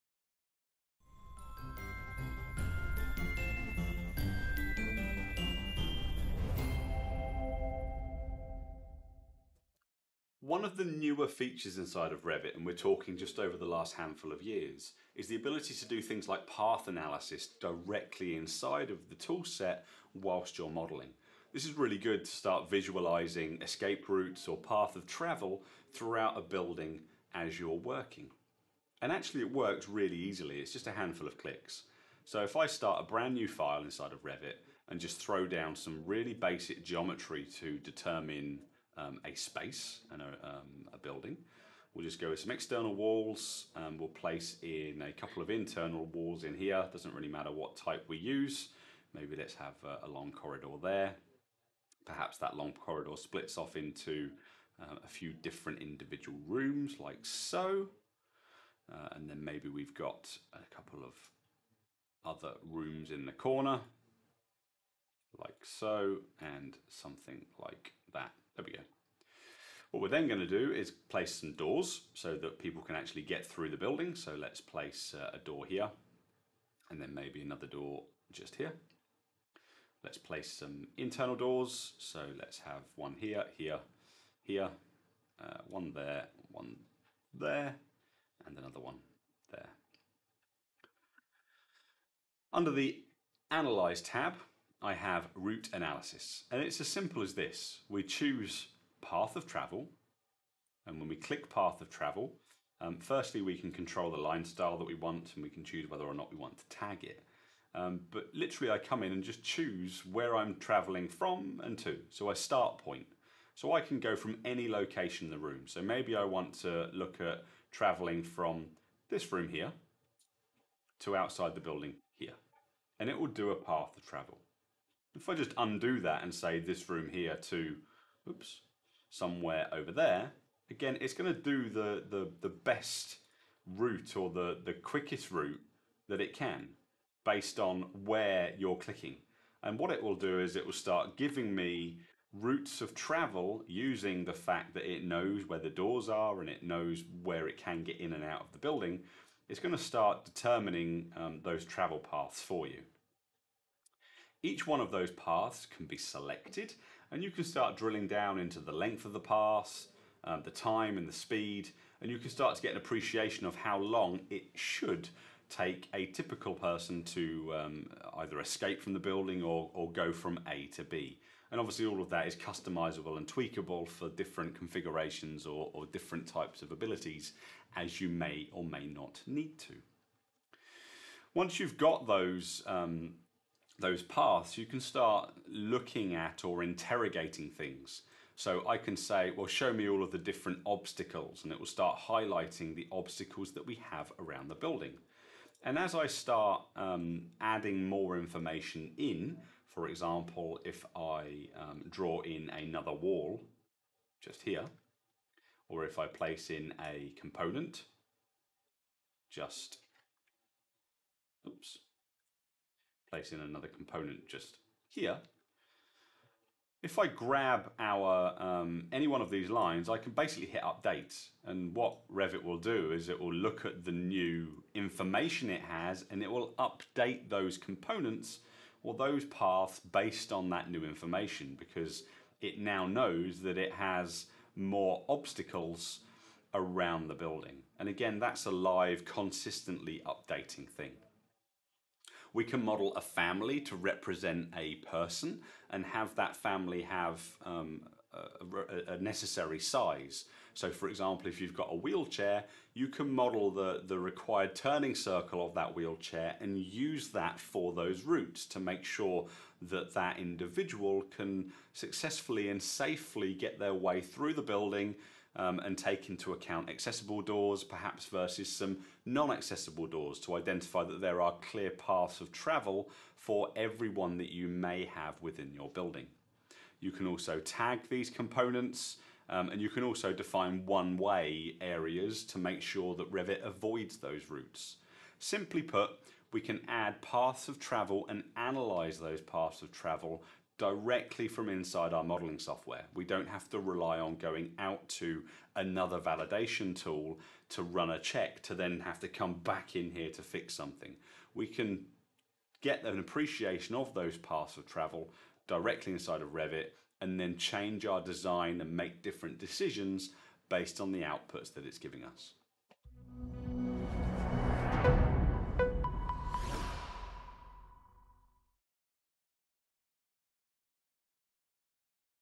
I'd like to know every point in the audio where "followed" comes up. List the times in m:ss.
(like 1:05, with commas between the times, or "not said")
not said.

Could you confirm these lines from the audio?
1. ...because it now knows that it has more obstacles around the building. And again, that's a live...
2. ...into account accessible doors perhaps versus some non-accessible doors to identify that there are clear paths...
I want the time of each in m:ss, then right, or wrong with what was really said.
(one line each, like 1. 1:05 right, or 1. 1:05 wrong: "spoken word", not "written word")
1. 3:51 right
2. 4:26 right.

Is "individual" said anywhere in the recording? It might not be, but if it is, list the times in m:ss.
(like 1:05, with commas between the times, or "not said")
0:55, 4:20.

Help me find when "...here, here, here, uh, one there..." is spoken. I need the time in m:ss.
1:23.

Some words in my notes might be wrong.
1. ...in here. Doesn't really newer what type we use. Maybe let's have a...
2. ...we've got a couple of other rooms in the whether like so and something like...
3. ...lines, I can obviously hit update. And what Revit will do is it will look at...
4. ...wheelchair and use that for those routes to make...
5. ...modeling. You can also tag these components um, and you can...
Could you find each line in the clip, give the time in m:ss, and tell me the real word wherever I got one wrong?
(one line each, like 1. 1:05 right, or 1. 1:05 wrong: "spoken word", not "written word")
1. 0:46 wrong: "matter", not "newer"
2. 0:59 wrong: "corner", not "whether"
3. 3:39 wrong: "basically", not "obviously"
4. 4:15 right
5. 4:35 wrong: "building", not "modeling".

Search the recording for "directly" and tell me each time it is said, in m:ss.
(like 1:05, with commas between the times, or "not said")
0:17, 4:50, 5:05.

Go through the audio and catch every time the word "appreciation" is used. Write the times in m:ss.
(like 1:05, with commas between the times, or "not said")
2:42, 5:02.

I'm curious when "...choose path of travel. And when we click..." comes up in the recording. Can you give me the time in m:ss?
1:38.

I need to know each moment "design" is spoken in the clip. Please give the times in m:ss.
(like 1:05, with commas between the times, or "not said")
5:07.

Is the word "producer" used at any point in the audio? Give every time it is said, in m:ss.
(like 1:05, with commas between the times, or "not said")
not said.